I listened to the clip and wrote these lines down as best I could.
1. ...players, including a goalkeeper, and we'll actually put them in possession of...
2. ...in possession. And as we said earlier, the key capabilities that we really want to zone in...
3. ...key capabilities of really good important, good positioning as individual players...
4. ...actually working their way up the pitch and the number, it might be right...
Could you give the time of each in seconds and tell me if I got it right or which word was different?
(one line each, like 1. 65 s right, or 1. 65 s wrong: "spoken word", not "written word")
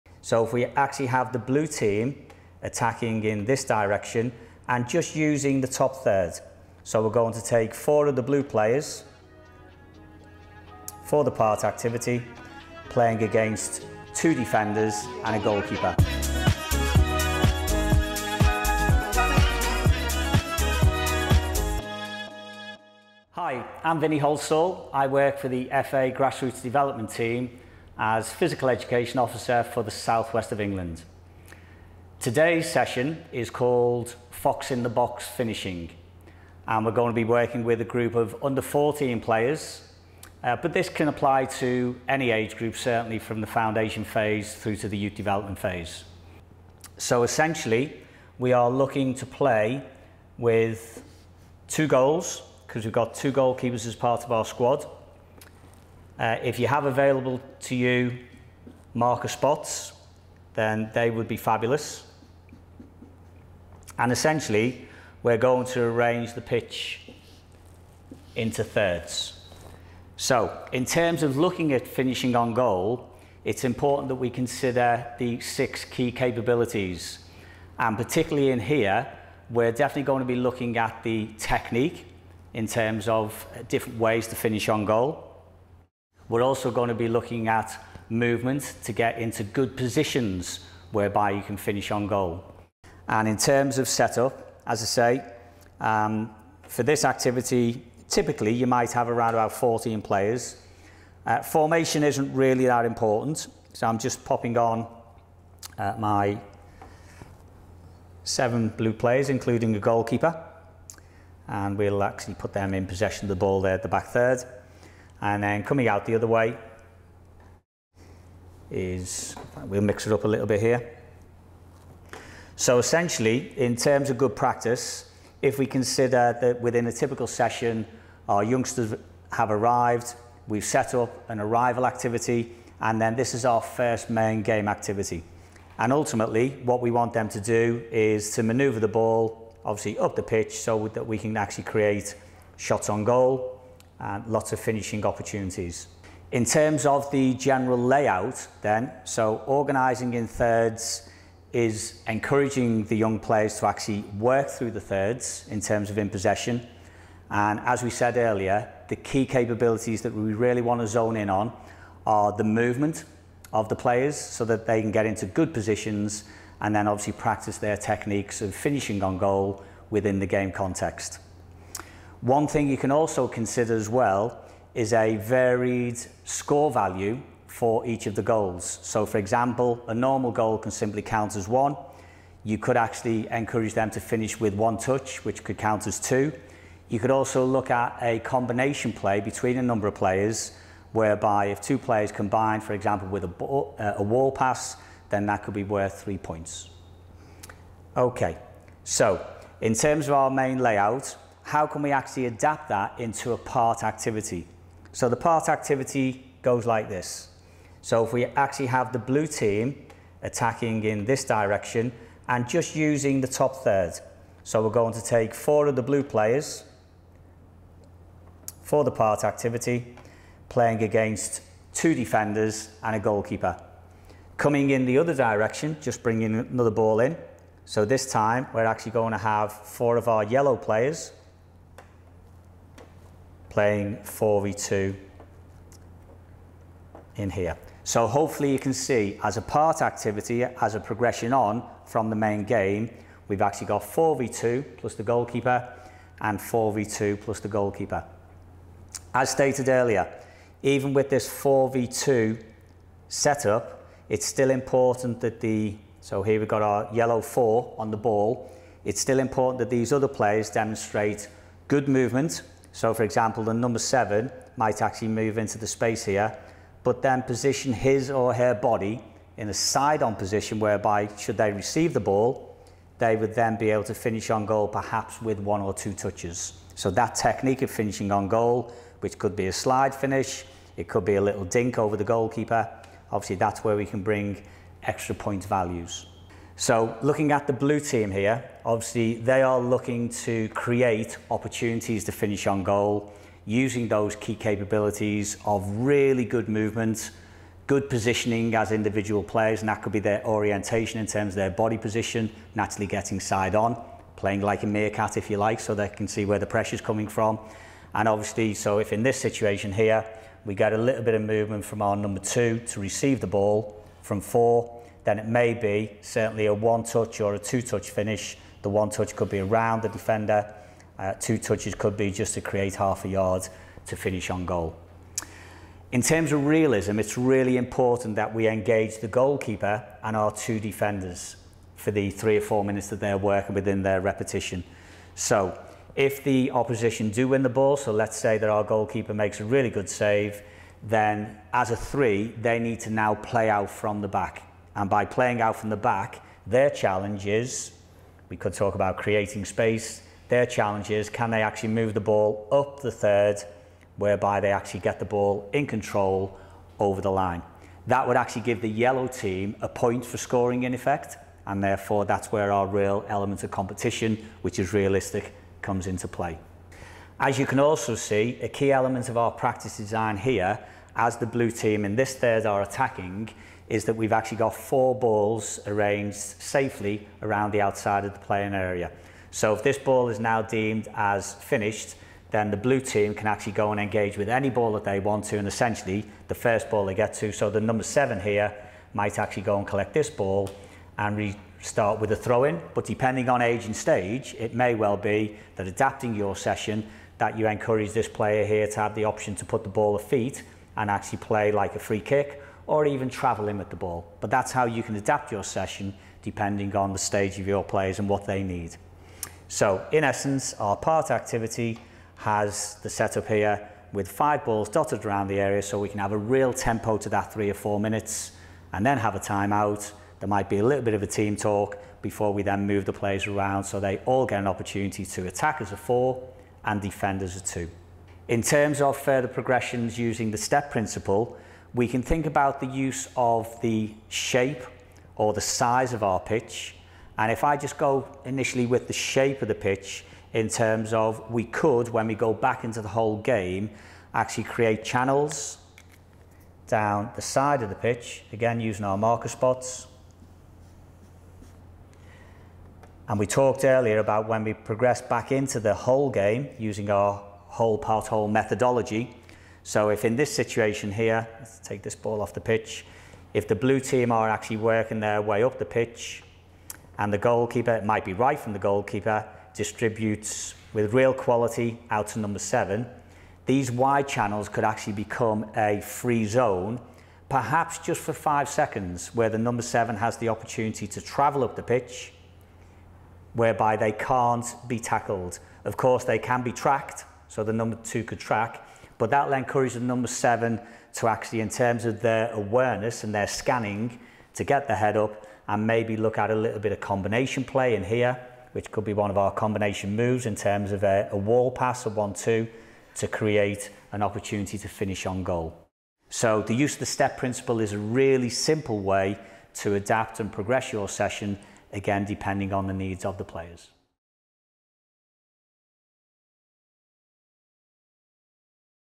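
1. 108 s right
2. 155 s right
3. 294 s wrong: "movement", not "important"
4. 464 s wrong: "goalkeeper", not "number".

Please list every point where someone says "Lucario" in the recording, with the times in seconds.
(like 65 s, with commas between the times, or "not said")
not said.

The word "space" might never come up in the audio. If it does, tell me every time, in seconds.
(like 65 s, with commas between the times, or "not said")
265 s, 349 s.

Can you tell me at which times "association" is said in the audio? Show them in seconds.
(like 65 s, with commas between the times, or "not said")
not said.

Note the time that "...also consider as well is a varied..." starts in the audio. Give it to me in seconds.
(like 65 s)
172 s.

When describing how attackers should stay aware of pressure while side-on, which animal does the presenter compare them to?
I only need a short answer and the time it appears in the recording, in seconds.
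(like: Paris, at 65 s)
meerkat, at 304 s.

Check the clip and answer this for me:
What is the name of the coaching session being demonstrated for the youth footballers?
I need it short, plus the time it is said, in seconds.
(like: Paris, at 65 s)
Fox in the Box Finishing, at 34 s.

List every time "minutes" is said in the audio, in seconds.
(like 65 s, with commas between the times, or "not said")
332 s, 417 s.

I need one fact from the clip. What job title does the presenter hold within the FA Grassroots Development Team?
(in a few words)
Physical Education Officer.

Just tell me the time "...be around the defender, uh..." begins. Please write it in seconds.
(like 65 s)
319 s.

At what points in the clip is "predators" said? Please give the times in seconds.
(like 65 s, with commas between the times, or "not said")
not said.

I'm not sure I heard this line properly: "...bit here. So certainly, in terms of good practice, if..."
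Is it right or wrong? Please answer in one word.
wrong.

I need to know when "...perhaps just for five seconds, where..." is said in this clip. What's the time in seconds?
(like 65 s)
477 s.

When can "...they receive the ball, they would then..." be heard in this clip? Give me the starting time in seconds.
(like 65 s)
271 s.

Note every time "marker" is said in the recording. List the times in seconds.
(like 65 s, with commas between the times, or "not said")
58 s, 448 s.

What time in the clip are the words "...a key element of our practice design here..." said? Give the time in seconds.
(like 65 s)
368 s.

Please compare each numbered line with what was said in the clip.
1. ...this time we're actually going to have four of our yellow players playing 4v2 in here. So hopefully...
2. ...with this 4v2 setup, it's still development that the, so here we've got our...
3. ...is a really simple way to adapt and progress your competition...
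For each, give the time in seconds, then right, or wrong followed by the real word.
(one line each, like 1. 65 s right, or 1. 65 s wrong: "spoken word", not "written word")
1. 227 s right
2. 250 s wrong: "important", not "development"
3. 507 s wrong: "session", not "competition".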